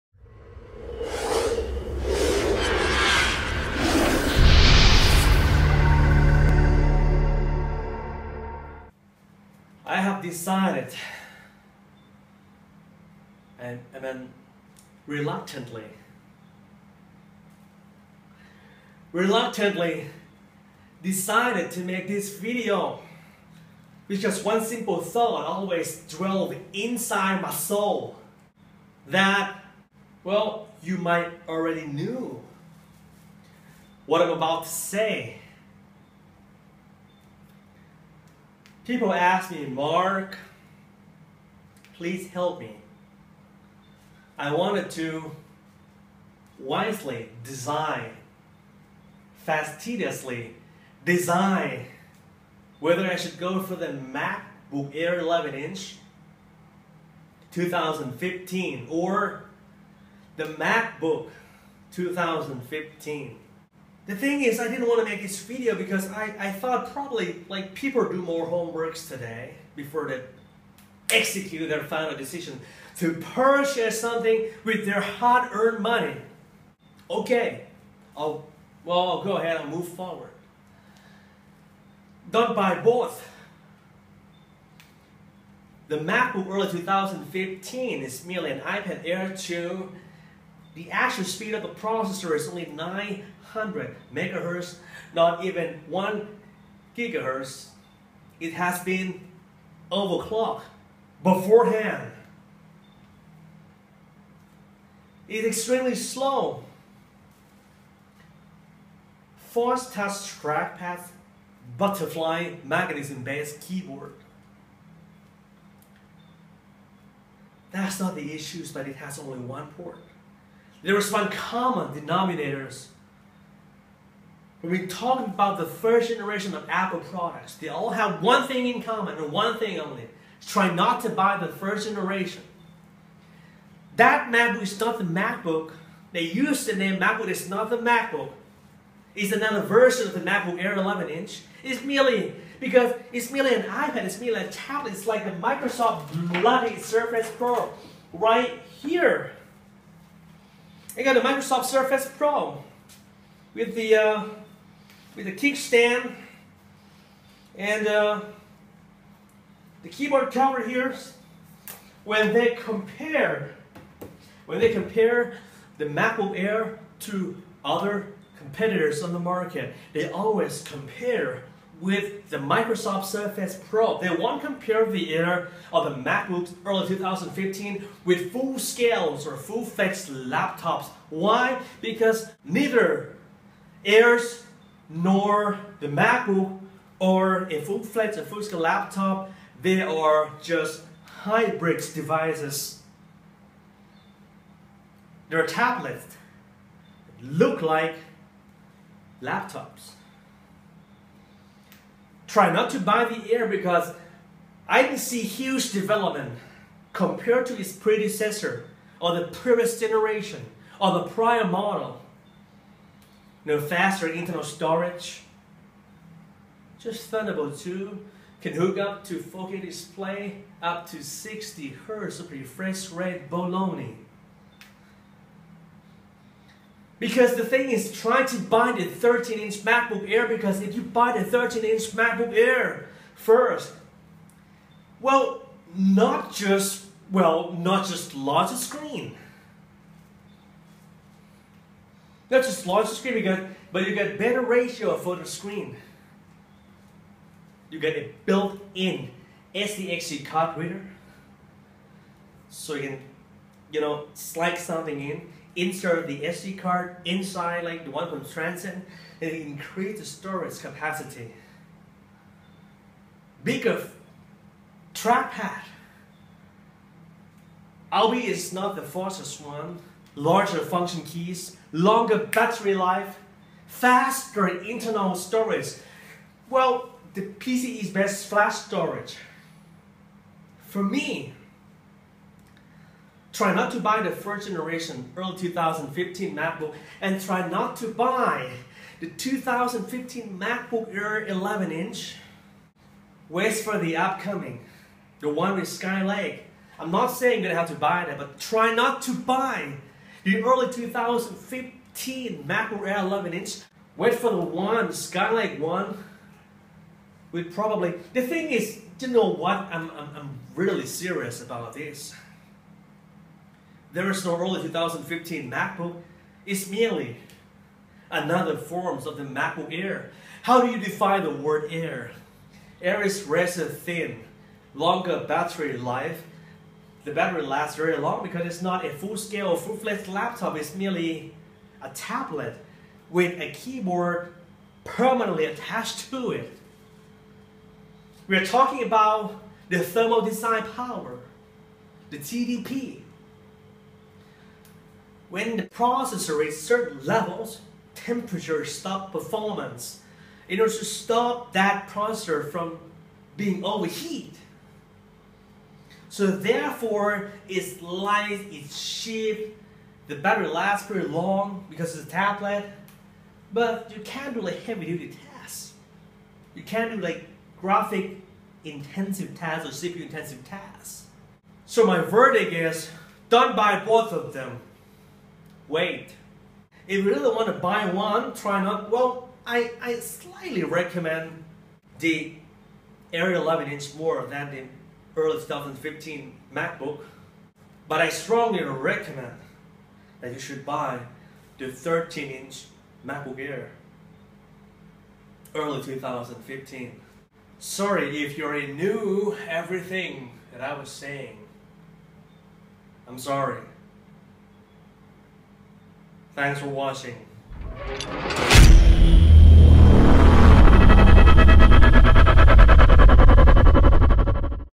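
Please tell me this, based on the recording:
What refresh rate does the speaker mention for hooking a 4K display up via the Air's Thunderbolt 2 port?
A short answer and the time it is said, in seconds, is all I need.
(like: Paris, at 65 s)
60 Hz, at 221 s.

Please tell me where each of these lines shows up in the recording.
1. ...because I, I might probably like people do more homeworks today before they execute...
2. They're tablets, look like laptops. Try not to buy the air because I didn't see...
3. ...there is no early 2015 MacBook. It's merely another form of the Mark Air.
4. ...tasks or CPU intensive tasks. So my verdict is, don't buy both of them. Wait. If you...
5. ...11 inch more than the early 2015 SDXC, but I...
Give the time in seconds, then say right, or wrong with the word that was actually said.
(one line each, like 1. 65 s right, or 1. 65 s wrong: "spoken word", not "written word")
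1. 65 s wrong: "thought", not "might"
2. 195 s right
3. 313 s wrong: "MacBook", not "Mark"
4. 369 s right
5. 383 s wrong: "MacBook", not "SDXC".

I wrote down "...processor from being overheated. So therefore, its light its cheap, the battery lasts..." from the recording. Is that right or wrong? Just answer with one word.
right.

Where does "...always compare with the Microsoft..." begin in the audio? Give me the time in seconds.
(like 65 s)
170 s.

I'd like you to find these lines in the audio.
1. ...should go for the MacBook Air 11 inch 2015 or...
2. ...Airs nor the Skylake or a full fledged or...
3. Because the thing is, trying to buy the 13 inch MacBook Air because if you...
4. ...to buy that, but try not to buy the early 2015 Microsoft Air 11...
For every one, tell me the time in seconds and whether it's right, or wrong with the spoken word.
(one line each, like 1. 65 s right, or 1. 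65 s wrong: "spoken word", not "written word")
1. 53 s right
2. 183 s wrong: "MacBook", not "Skylake"
3. 227 s right
4. 297 s wrong: "MacBook", not "Microsoft".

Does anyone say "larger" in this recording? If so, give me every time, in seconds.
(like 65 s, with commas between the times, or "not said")
238 s, 242 s, 270 s.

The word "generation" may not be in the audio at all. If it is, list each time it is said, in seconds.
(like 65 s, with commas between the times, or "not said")
126 s, 131 s, 209 s, 284 s.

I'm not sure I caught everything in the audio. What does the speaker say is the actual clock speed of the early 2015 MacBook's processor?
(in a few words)
900 megahertz.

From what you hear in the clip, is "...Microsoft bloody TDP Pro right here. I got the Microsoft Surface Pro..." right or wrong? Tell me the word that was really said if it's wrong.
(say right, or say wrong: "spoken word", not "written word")
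wrong: "Surface", not "TDP".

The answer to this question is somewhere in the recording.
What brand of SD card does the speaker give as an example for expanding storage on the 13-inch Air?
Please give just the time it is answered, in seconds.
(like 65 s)
258 s.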